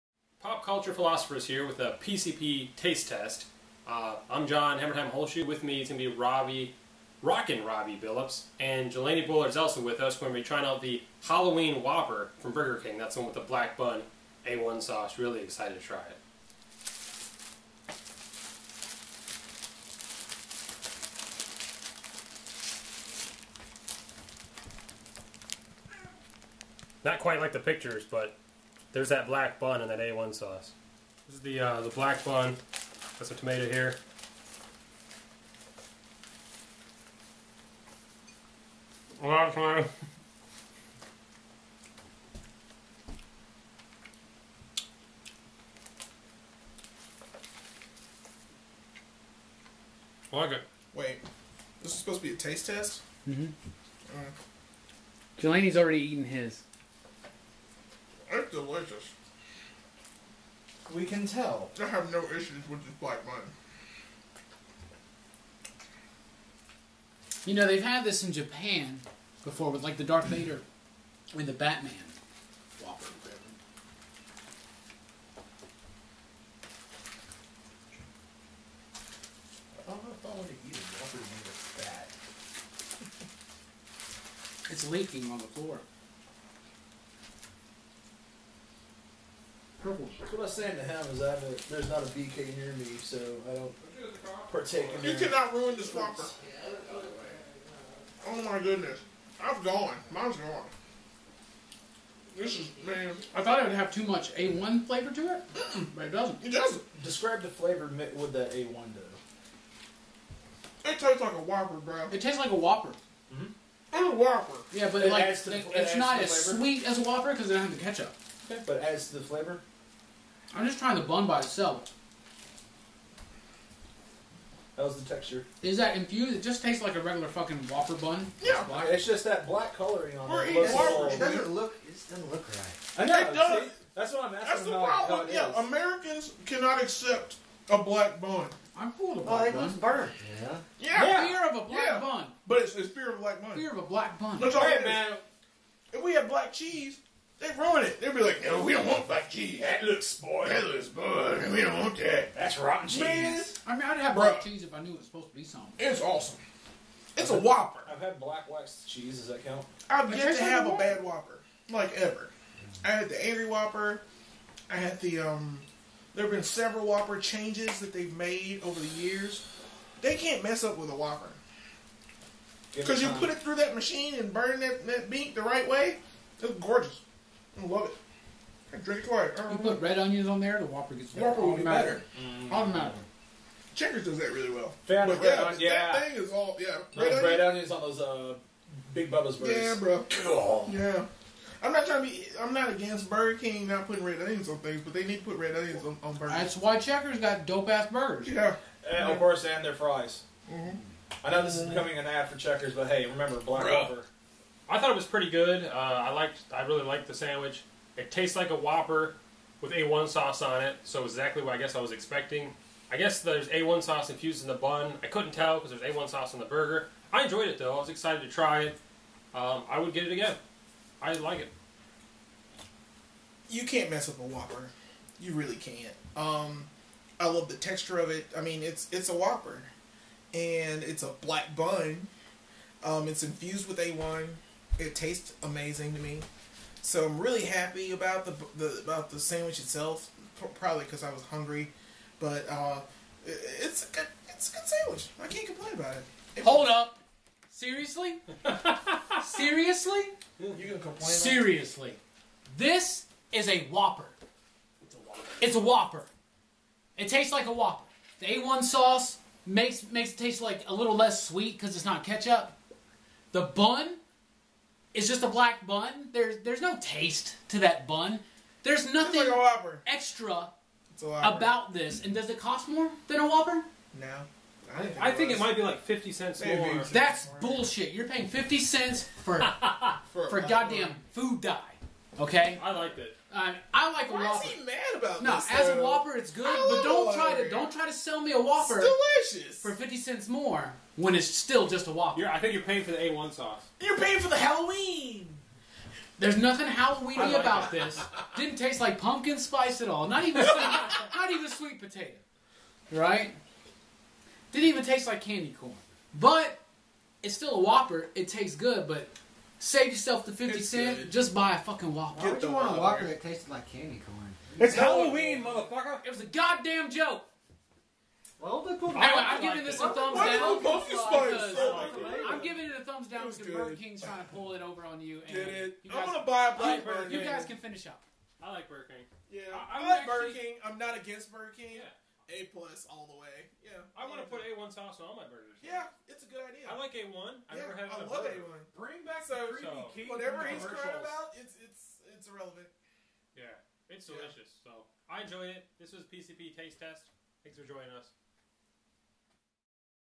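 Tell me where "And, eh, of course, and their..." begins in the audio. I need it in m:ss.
3:18.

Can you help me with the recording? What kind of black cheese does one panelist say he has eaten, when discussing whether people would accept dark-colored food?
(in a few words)
black wax cheese.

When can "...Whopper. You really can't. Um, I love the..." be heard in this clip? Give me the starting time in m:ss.
3:44.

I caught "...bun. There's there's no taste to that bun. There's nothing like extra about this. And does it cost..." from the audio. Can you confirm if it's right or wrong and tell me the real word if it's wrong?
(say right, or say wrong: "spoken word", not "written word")
right.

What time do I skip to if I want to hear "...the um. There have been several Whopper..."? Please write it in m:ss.
2:45.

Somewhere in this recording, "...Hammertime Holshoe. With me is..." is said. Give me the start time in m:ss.
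0:04.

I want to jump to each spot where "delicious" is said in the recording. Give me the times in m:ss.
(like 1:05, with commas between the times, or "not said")
0:58, 4:49, 5:44.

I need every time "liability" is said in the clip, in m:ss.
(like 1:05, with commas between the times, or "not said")
not said.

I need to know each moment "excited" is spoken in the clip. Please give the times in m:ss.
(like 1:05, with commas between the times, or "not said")
0:15, 3:37.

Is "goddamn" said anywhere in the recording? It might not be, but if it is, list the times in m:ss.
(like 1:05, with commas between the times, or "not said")
4:40, 5:16.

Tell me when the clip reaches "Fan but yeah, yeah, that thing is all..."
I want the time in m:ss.
3:04.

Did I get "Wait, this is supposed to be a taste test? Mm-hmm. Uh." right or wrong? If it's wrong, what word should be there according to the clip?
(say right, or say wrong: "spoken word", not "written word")
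right.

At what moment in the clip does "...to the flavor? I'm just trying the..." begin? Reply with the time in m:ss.
1:59.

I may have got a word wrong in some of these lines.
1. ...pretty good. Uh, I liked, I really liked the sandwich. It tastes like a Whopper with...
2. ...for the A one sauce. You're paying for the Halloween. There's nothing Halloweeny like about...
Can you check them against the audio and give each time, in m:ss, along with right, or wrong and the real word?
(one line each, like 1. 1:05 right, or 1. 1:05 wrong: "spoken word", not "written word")
1. 3:25 right
2. 4:52 right.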